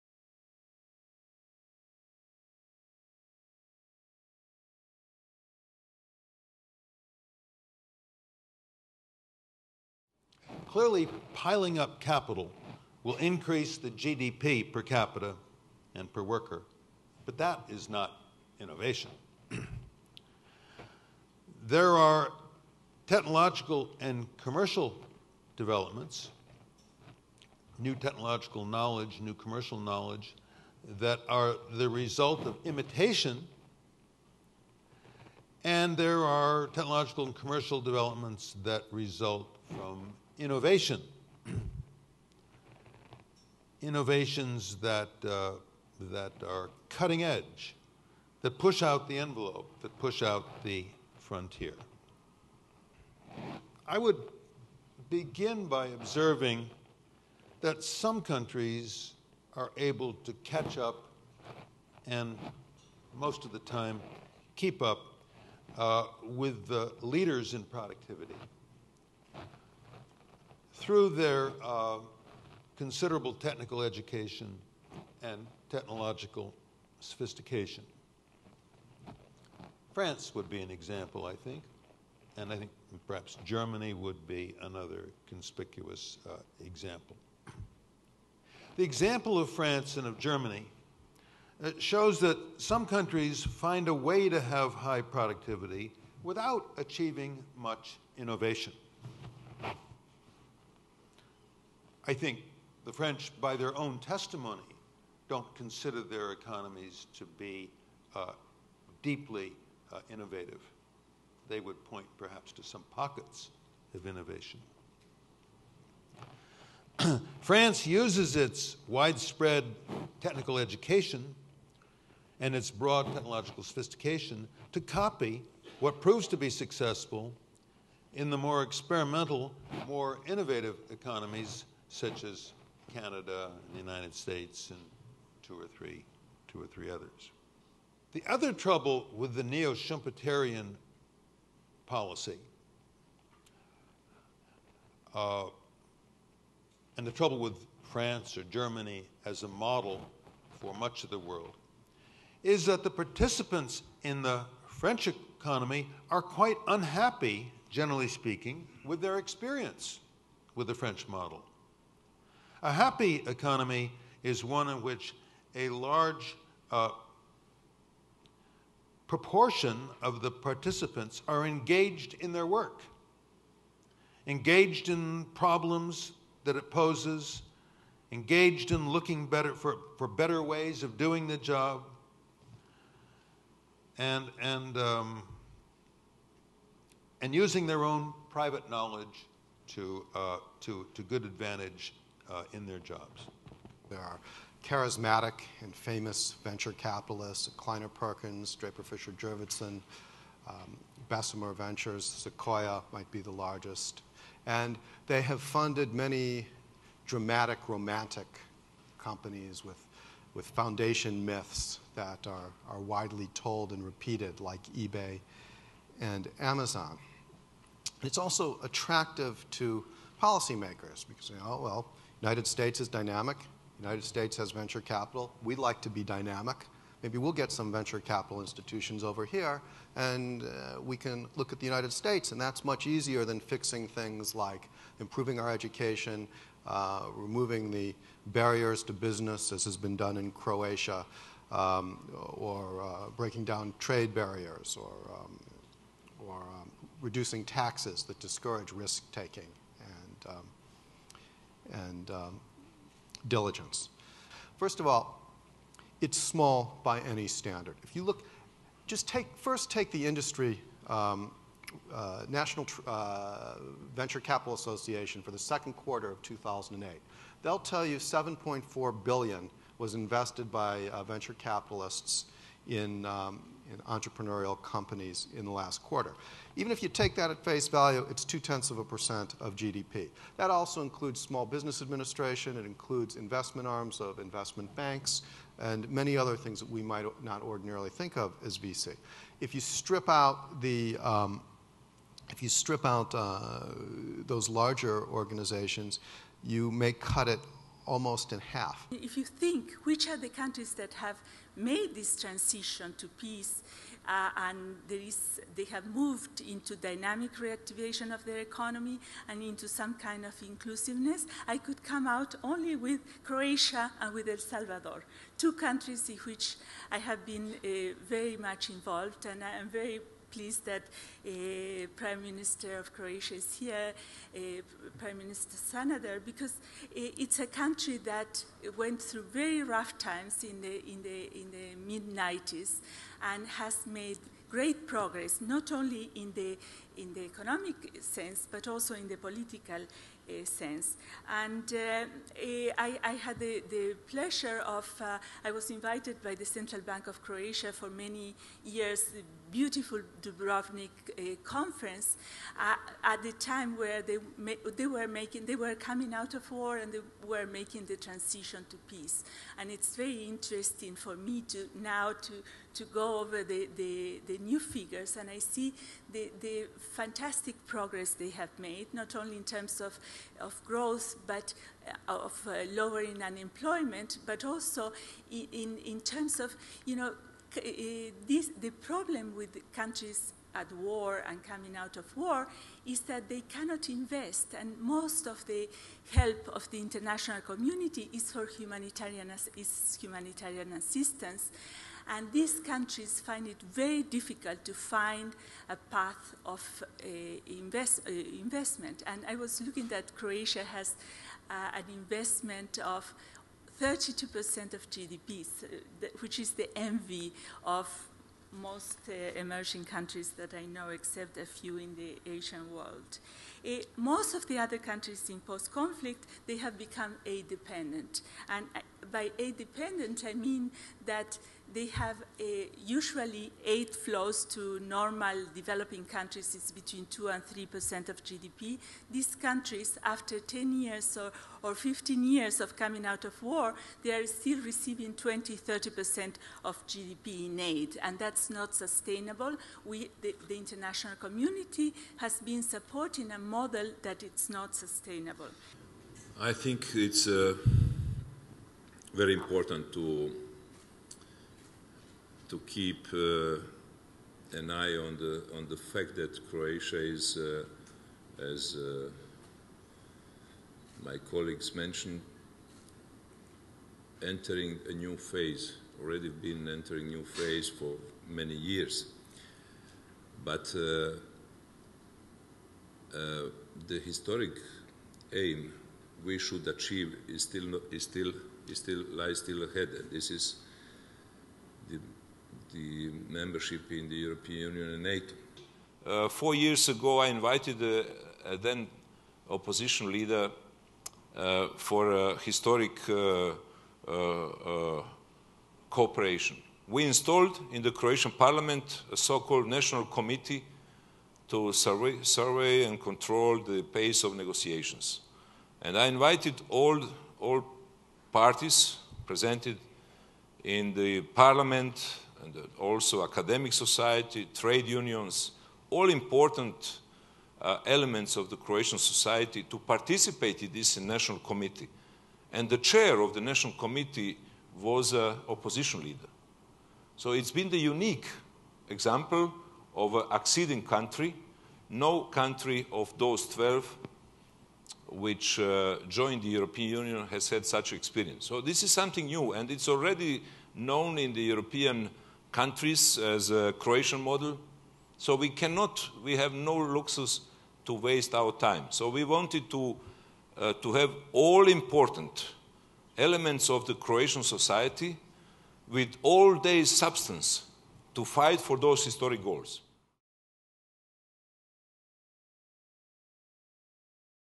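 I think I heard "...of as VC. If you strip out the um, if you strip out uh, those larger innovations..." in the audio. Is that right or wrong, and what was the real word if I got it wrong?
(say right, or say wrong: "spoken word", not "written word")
wrong: "organizations", not "innovations".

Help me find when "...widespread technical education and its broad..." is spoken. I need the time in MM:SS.
01:58.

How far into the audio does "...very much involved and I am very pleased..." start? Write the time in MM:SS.
05:18.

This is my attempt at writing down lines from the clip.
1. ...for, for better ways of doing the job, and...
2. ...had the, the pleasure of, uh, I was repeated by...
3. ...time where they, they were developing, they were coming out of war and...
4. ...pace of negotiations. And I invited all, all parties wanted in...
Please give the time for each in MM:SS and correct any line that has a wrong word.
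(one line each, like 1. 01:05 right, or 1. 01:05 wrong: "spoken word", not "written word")
1. 02:59 right
2. 05:43 wrong: "invited", not "repeated"
3. 05:53 wrong: "making", not "developing"
4. 08:23 wrong: "presented", not "wanted".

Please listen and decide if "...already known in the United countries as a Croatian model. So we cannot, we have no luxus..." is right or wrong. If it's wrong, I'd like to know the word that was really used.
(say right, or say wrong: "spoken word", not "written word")
wrong: "European", not "United".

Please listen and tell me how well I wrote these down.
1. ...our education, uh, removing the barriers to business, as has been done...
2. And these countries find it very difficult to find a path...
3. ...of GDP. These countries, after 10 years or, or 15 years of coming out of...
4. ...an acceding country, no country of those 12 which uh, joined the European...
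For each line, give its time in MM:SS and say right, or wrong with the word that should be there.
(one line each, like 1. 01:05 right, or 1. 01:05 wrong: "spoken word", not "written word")
1. 03:55 right
2. 06:32 right
3. 07:08 right
4. 08:50 right.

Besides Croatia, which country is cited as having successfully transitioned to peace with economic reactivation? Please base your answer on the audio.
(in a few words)
El Salvador.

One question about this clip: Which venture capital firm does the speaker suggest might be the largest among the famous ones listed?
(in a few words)
Sequoia.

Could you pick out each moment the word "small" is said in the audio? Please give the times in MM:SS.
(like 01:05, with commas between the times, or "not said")
04:16, 04:41.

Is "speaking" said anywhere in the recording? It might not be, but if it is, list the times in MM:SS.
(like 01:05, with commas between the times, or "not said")
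02:38.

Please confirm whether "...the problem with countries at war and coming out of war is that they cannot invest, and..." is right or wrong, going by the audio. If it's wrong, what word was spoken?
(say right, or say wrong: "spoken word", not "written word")
right.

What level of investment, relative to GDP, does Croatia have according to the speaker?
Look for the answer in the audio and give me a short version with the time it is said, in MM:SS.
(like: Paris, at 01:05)
32%, at 06:43.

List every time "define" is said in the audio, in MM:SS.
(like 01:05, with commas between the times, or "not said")
not said.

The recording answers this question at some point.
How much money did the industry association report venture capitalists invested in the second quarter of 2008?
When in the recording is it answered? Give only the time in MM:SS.
04:27.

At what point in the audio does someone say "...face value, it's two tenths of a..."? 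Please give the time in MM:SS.
04:37.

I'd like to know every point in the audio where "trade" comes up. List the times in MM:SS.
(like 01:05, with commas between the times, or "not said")
04:03, 08:34.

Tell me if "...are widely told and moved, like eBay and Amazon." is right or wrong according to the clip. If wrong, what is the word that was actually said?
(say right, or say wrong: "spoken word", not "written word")
wrong: "repeated", not "moved".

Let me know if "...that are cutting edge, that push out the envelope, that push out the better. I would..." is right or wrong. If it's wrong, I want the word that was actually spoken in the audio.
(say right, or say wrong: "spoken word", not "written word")
wrong: "frontier", not "better".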